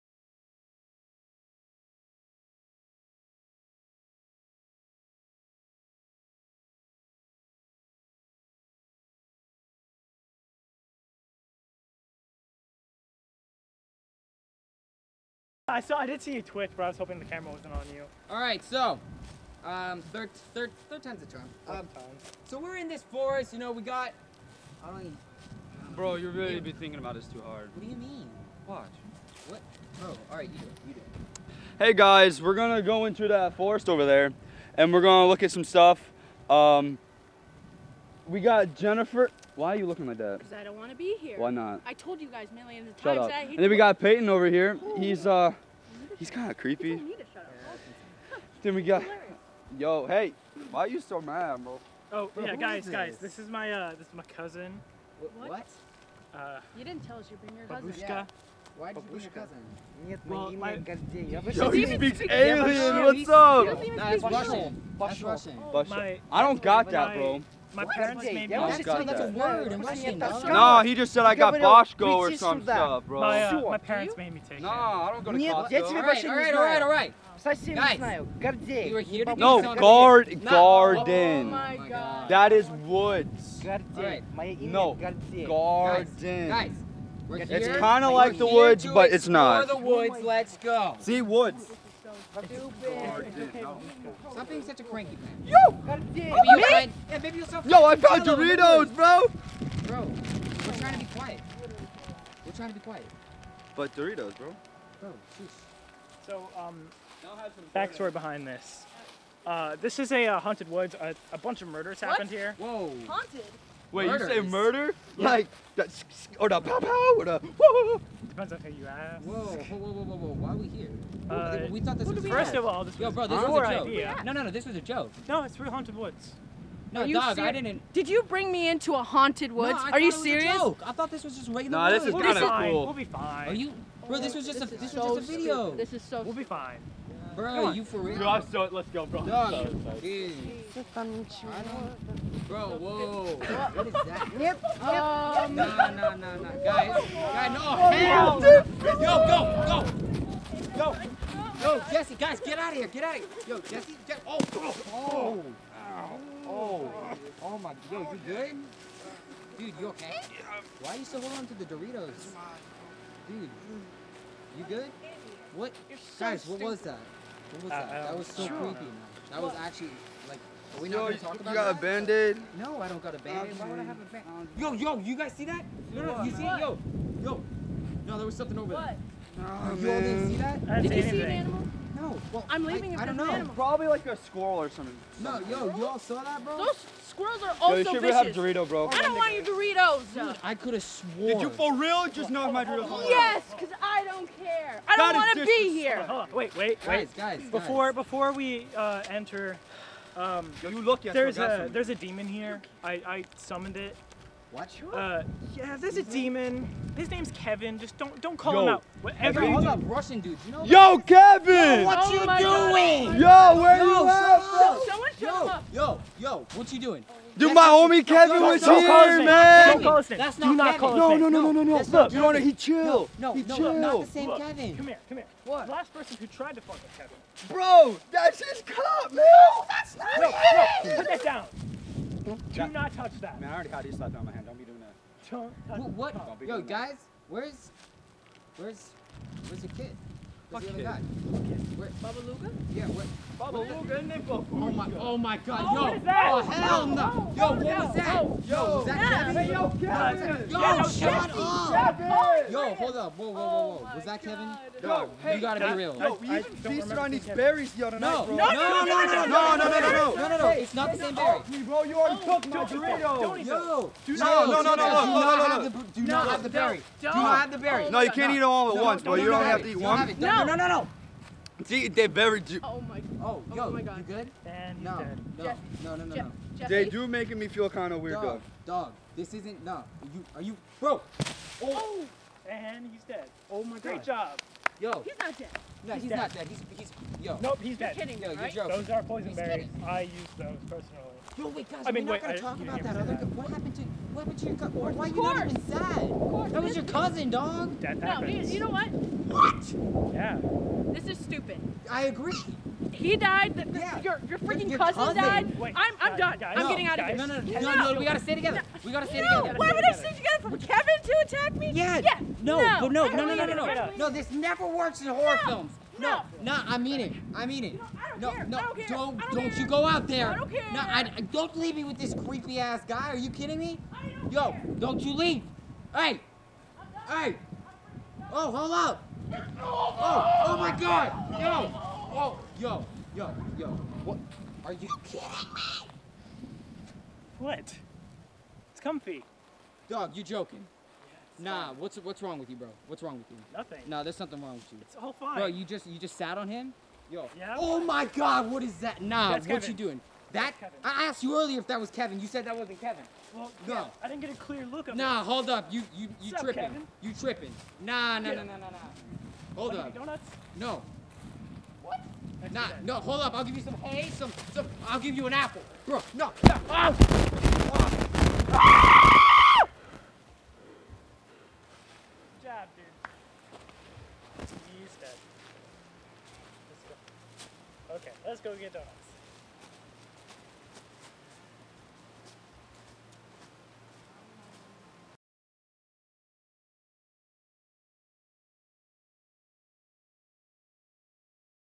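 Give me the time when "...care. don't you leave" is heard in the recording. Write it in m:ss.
5:24.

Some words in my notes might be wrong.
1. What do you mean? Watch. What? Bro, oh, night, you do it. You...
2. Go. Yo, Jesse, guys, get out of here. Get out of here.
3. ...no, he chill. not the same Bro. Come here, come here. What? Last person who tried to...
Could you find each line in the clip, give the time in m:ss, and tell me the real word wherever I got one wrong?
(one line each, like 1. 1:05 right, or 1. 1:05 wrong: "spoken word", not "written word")
1. 0:27 wrong: "alright", not "night"
2. 2:30 right
3. 3:43 wrong: "Kevin", not "Bro".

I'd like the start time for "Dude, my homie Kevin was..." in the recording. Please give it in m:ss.
3:37.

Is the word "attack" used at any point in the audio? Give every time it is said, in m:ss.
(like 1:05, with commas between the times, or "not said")
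5:11.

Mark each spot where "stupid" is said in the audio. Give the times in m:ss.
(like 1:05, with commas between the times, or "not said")
2:15, 5:01.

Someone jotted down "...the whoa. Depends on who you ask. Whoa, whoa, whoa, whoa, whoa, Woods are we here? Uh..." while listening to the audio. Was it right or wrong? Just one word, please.
wrong.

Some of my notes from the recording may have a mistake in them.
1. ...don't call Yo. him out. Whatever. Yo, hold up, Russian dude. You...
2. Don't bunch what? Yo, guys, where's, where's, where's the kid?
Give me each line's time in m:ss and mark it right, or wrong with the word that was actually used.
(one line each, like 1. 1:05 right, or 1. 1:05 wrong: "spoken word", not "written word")
1. 3:28 right
2. 3:55 wrong: "touch", not "bunch".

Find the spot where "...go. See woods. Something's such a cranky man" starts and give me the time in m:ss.
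1:30.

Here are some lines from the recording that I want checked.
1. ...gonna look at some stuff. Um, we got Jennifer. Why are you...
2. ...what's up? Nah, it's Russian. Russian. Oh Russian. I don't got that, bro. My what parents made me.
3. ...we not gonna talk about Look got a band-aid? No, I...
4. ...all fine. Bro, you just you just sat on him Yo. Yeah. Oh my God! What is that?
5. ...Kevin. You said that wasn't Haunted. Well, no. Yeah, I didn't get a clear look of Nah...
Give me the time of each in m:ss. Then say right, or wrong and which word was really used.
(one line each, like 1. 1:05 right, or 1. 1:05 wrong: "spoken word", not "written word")
1. 0:35 right
2. 1:03 right
3. 2:50 wrong: "You", not "Look"
4. 5:45 right
5. 5:51 wrong: "Kevin", not "Haunted".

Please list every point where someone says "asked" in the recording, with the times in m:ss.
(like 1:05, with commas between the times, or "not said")
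5:51.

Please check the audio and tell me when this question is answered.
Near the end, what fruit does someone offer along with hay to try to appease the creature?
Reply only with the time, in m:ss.
6:04.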